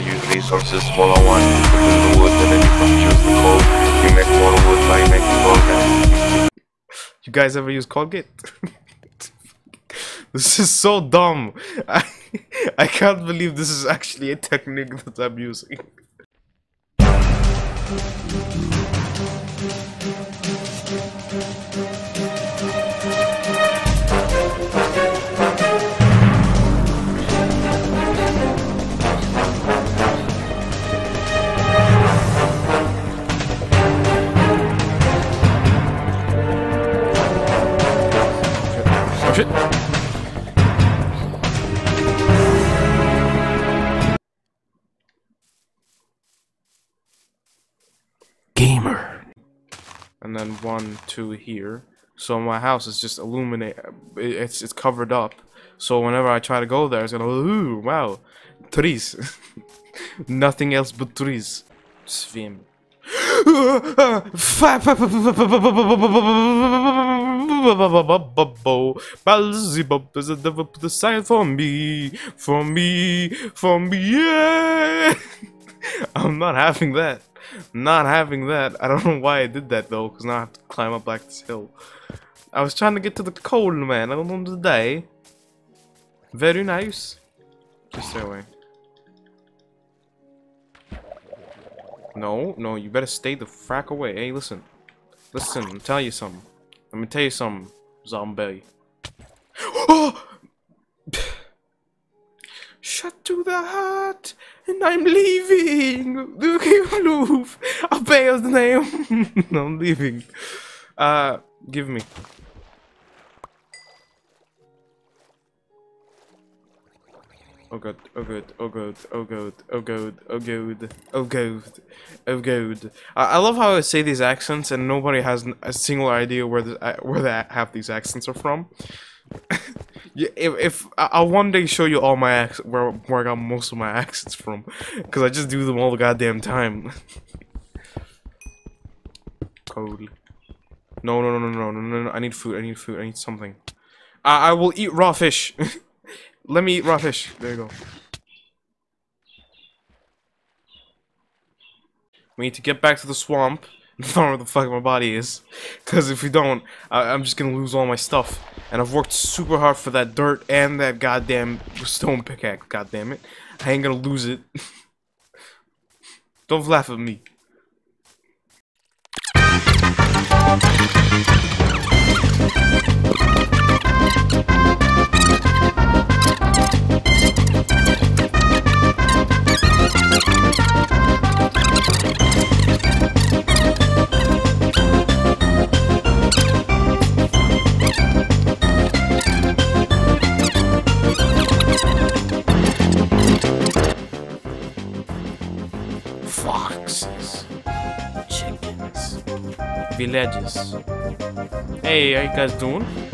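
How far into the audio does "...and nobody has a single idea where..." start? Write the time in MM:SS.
02:04.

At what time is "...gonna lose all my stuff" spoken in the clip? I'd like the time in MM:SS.
02:37.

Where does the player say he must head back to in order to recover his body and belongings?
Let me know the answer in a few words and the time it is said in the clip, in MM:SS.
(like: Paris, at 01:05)
The swamp, at 02:33.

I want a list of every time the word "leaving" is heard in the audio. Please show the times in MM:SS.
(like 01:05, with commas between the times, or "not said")
01:45, 01:49.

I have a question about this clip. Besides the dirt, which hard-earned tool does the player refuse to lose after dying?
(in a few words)
Stone pickaxe.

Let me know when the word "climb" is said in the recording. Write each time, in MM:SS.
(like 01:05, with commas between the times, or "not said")
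01:20.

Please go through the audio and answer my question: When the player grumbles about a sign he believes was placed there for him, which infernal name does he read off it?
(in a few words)
Beelzebub.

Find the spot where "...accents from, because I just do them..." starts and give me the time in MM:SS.
02:13.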